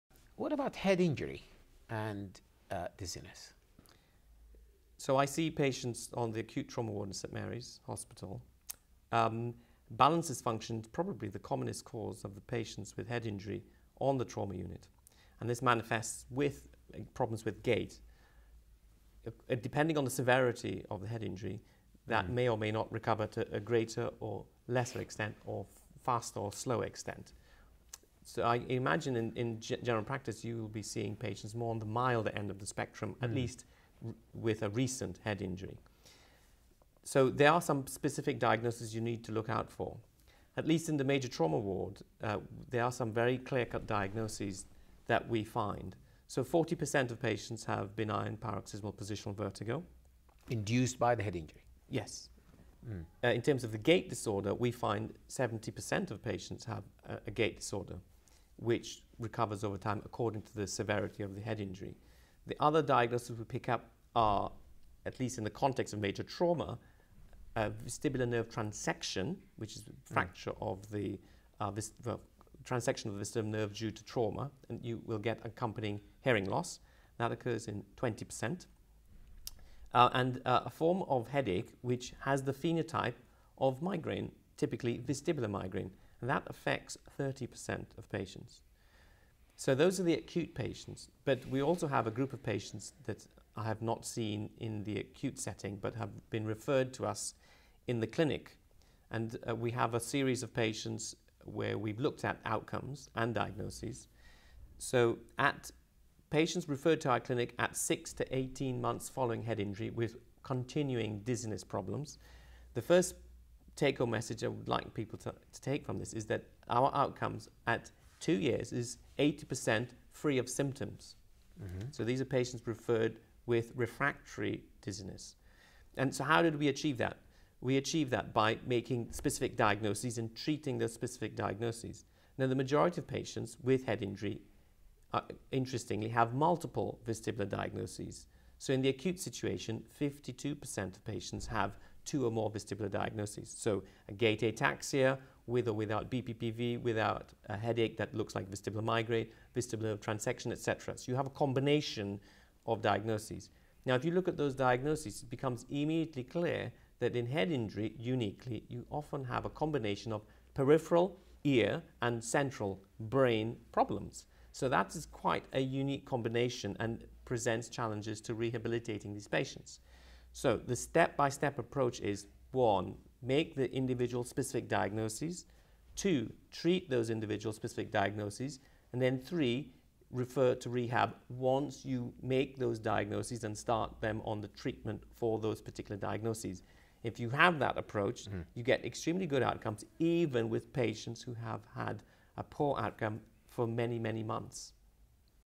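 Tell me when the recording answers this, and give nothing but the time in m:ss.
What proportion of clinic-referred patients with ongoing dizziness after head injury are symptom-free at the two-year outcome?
1:59.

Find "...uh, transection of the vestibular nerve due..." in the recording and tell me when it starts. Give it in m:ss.
1:11.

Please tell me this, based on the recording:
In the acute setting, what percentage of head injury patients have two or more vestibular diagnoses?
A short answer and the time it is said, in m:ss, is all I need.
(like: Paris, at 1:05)
52%, at 2:19.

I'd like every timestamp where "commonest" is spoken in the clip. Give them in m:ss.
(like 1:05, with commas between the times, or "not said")
0:11.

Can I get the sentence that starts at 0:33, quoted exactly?
at least with a recent head injury.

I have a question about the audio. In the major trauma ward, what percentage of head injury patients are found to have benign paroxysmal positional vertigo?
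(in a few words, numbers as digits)
40%.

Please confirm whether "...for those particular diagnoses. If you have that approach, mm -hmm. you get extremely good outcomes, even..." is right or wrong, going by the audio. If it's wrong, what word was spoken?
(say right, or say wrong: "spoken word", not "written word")
right.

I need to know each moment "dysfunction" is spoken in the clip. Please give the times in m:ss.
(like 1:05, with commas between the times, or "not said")
0:10.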